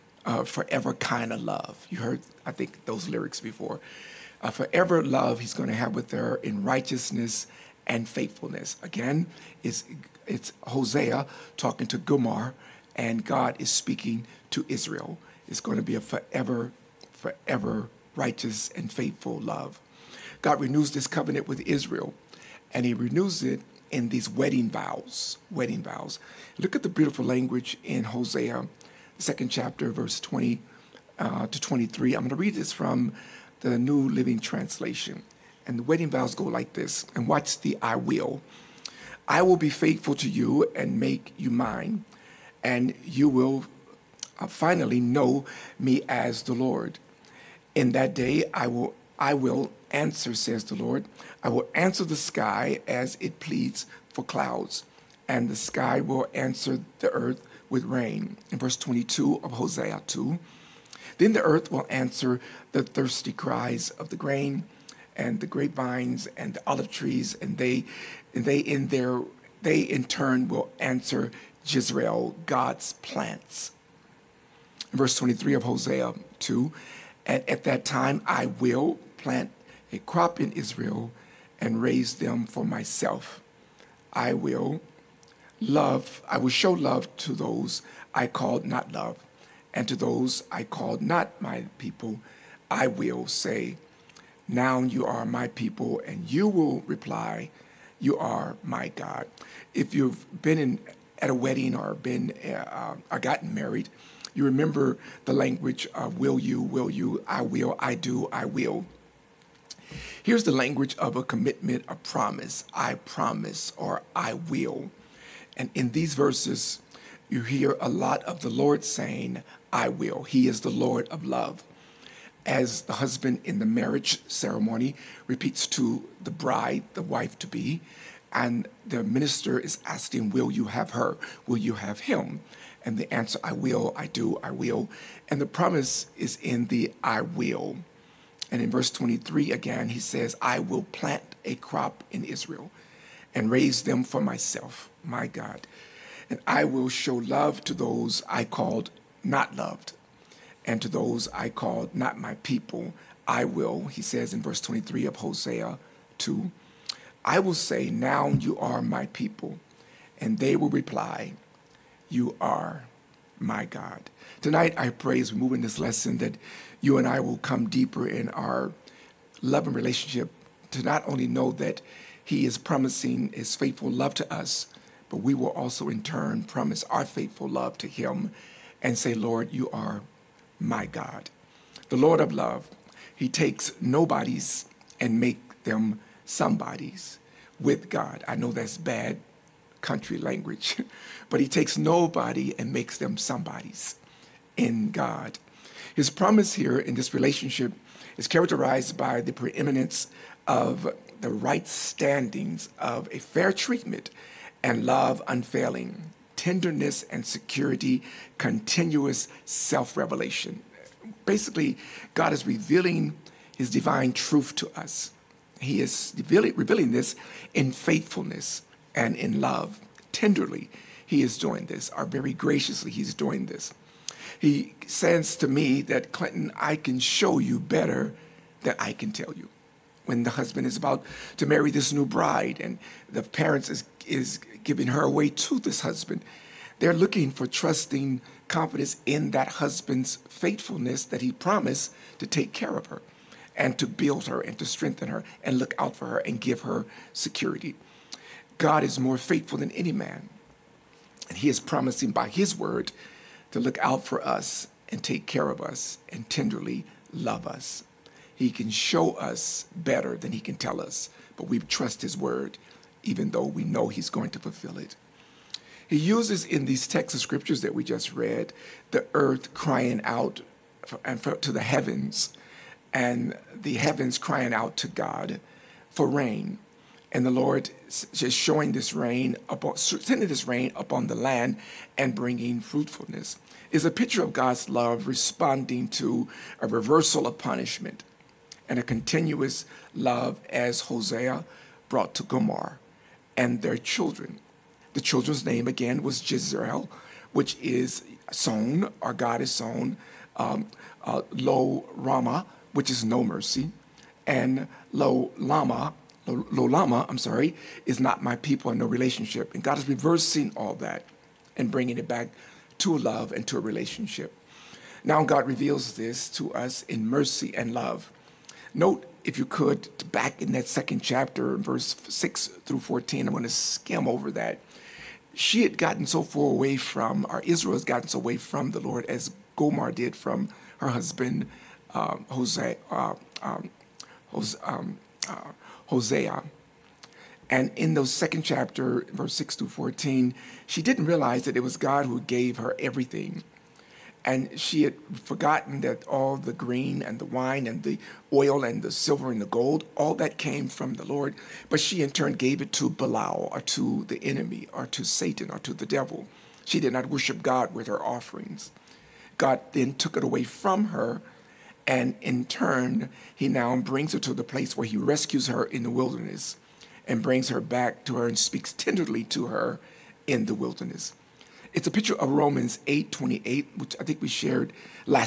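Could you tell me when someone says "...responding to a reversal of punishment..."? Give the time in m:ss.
4:45.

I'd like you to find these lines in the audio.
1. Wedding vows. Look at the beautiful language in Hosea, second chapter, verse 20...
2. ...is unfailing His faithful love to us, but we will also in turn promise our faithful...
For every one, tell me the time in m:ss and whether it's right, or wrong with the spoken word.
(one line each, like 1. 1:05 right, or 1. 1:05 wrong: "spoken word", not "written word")
1. 0:25 right
2. 2:52 wrong: "promising", not "unfailing".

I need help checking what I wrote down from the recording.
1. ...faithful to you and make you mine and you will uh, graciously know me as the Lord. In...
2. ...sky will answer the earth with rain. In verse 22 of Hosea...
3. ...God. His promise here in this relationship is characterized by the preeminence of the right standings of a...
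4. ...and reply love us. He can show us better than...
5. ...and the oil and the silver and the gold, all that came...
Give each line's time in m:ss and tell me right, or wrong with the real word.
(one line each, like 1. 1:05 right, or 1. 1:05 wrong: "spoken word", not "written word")
1. 0:39 wrong: "finally", not "graciously"
2. 0:55 right
3. 3:14 right
4. 4:16 wrong: "tenderly", not "reply"
5. 5:47 right.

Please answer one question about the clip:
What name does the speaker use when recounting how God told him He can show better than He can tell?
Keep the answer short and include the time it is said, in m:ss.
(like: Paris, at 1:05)
Clinton, at 3:46.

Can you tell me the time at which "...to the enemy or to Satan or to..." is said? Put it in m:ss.
5:53.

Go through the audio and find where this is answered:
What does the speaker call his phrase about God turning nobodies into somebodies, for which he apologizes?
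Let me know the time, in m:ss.
3:08.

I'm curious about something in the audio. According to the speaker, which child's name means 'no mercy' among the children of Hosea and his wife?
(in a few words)
Lo Rama.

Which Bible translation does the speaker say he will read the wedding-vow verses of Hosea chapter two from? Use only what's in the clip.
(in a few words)
New Living Translation.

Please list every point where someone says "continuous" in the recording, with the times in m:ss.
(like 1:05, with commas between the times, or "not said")
3:28, 4:48.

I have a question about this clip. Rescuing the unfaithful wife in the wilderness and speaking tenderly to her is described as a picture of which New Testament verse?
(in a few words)
Romans 8:28.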